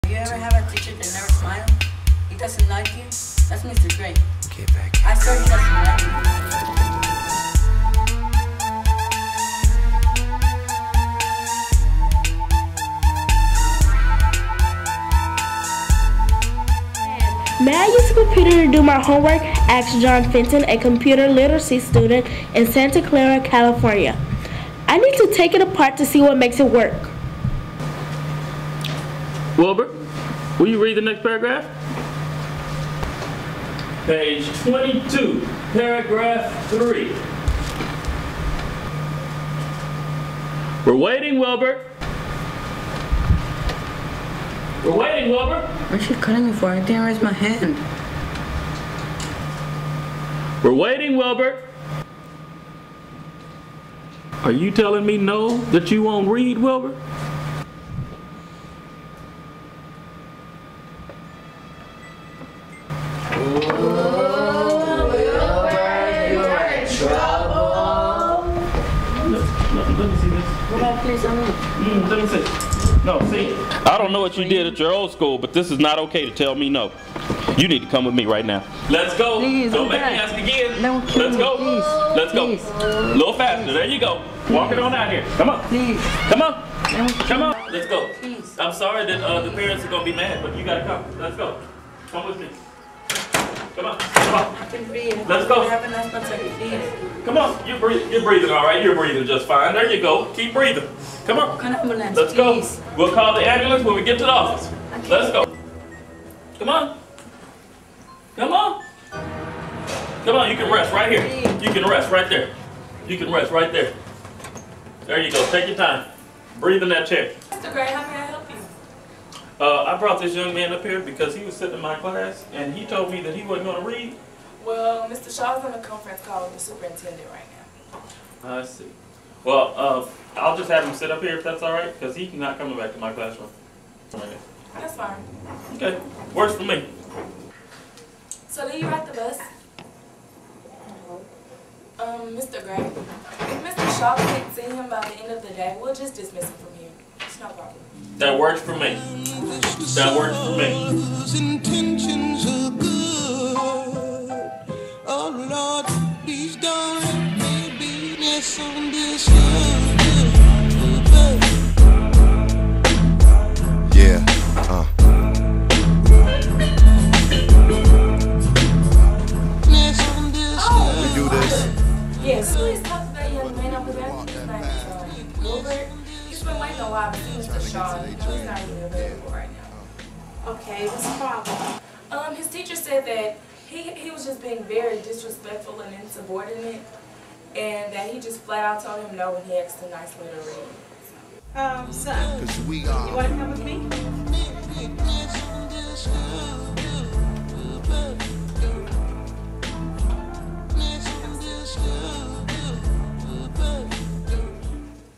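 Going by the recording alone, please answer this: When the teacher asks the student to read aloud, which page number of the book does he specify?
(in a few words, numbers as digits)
22.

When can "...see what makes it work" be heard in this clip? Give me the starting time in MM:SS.
00:26.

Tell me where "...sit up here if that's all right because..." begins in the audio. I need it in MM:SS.
02:10.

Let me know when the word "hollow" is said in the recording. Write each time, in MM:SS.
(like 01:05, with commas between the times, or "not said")
not said.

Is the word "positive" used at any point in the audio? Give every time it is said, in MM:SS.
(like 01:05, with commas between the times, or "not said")
not said.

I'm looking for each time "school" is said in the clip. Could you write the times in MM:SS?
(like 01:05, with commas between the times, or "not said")
01:15.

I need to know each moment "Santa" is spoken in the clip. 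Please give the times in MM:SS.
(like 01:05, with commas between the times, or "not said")
00:22.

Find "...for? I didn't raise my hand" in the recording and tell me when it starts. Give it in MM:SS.
00:46.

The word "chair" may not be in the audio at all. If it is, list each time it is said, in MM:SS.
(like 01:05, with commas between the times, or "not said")
01:57.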